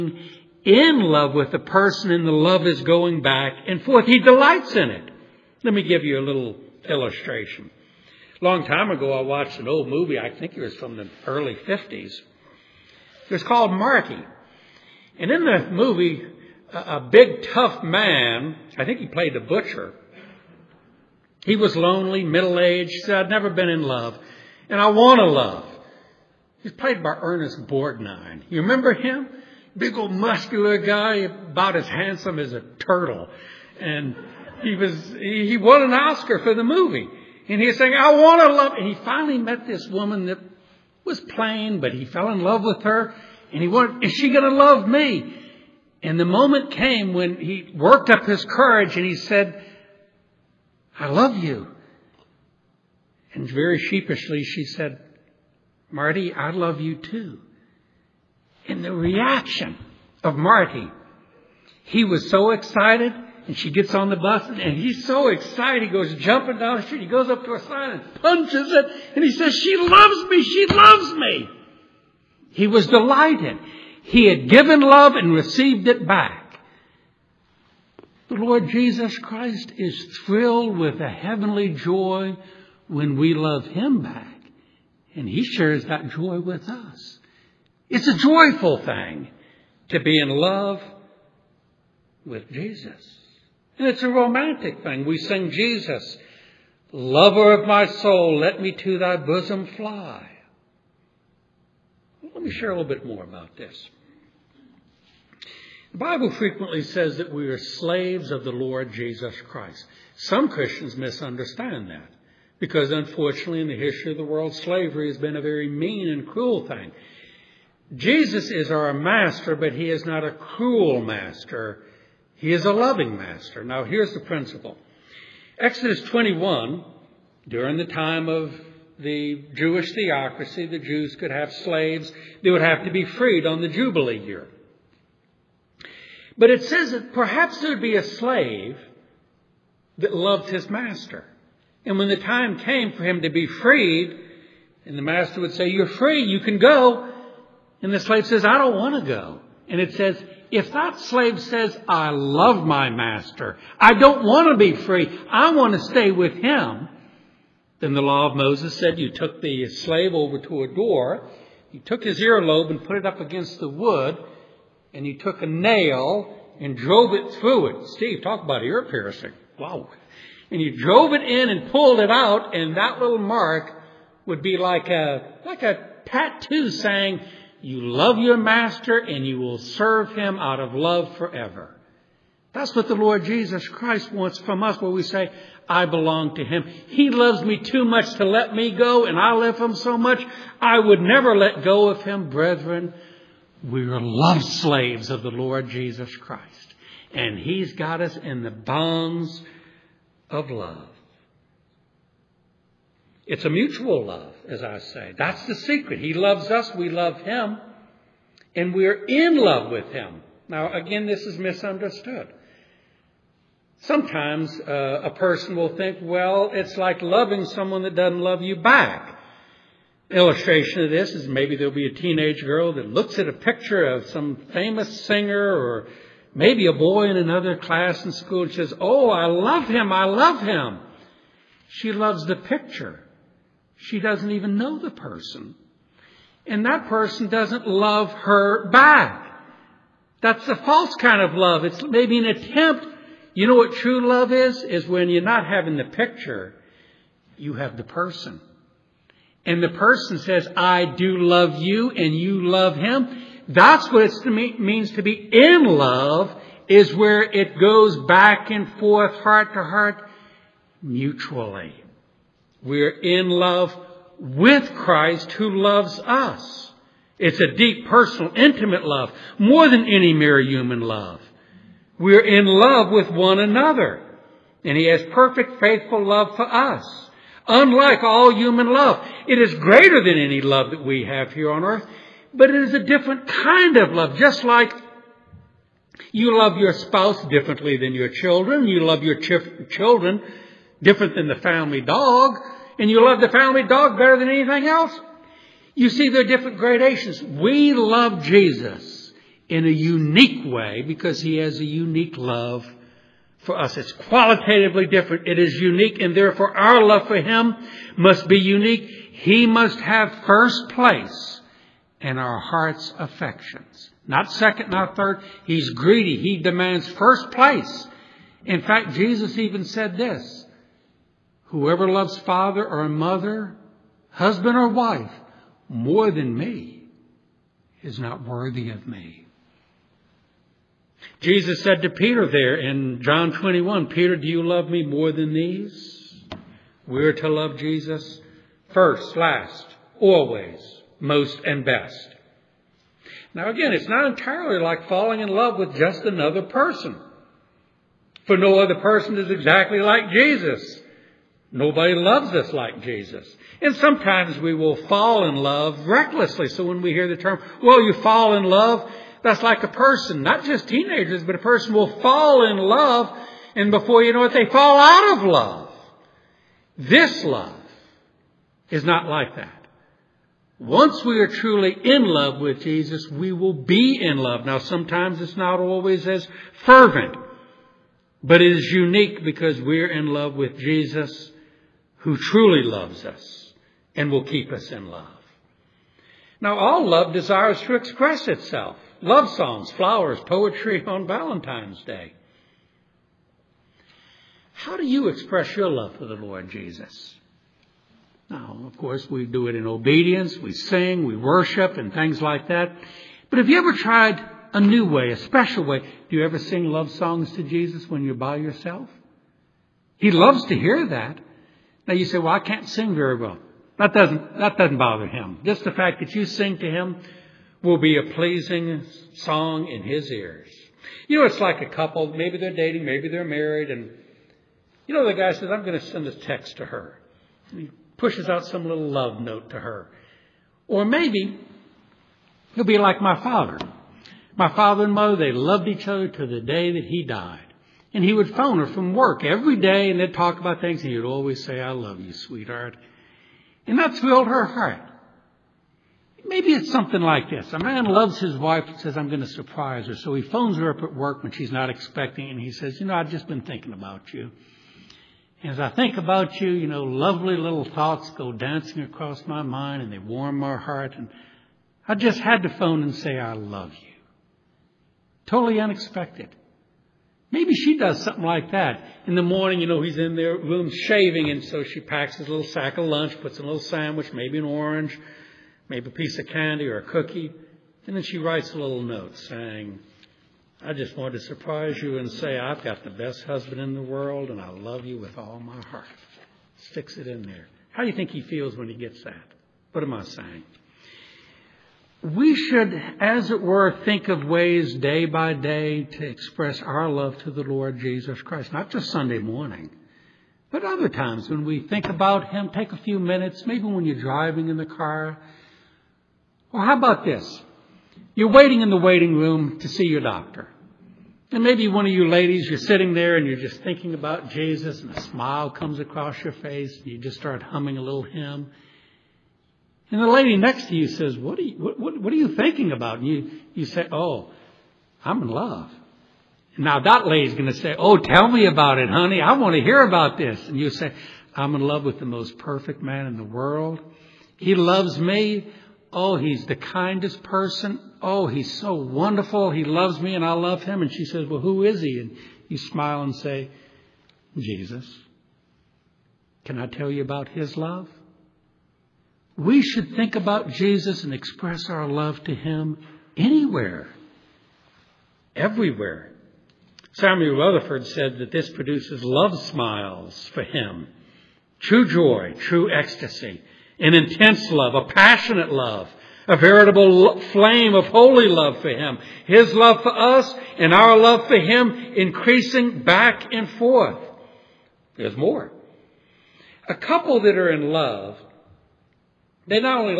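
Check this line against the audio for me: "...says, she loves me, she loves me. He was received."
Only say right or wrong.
wrong.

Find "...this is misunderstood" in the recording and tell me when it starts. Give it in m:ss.
3:31.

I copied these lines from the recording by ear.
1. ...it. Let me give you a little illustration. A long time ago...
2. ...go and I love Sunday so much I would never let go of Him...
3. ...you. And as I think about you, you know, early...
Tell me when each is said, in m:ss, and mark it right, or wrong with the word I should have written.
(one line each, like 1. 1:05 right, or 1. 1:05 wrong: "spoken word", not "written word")
1. 0:04 right
2. 3:08 wrong: "Him", not "Sunday"
3. 7:34 wrong: "lovely", not "early".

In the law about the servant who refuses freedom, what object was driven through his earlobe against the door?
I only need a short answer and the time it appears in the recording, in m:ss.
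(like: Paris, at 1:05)
A nail, at 2:45.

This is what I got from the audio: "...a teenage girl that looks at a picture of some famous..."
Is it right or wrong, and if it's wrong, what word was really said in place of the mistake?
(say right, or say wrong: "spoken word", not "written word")
right.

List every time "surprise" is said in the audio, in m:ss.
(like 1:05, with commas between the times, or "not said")
7:29, 8:01.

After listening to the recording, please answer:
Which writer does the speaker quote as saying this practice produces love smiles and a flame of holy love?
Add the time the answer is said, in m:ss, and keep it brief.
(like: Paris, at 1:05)
Samuel Rutherford, at 9:16.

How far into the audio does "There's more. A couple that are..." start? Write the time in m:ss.
9:34.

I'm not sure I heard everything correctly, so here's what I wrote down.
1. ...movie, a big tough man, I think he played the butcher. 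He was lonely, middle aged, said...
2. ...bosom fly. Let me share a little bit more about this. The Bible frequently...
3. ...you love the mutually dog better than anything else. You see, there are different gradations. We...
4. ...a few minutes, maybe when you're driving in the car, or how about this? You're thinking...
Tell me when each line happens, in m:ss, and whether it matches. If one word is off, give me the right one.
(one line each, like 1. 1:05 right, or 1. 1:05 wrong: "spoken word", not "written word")
1. 0:15 right
2. 1:39 right
3. 4:52 wrong: "family", not "mutually"
4. 8:22 wrong: "waiting", not "thinking".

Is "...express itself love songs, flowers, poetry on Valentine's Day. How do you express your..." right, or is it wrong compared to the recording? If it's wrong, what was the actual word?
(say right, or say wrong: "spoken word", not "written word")
right.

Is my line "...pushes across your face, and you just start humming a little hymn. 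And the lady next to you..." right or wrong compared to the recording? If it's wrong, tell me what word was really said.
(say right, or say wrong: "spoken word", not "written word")
wrong: "comes", not "pushes".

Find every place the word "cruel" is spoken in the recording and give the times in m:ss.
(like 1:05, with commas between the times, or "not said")
1:56, 2:00.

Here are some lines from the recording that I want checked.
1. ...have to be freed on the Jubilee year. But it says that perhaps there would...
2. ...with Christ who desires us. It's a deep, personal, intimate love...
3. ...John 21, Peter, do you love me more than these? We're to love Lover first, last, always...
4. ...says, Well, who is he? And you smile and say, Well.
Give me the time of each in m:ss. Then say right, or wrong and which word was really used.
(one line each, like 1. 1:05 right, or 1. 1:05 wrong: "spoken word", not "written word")
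1. 2:12 right
2. 4:24 wrong: "loves", not "desires"
3. 5:33 wrong: "Jesus", not "Lover"
4. 9:01 wrong: "Jesus", not "Well".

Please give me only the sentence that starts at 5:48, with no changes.
For no other person is exactly like Jesus.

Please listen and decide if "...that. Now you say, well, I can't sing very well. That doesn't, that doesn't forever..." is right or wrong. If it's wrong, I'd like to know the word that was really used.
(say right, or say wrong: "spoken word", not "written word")
wrong: "bother", not "forever".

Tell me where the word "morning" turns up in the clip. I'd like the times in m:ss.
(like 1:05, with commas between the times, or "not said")
7:49, 8:19.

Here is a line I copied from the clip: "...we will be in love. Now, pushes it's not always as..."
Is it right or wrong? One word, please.
wrong.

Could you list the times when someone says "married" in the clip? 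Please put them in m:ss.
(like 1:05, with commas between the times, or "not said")
7:03.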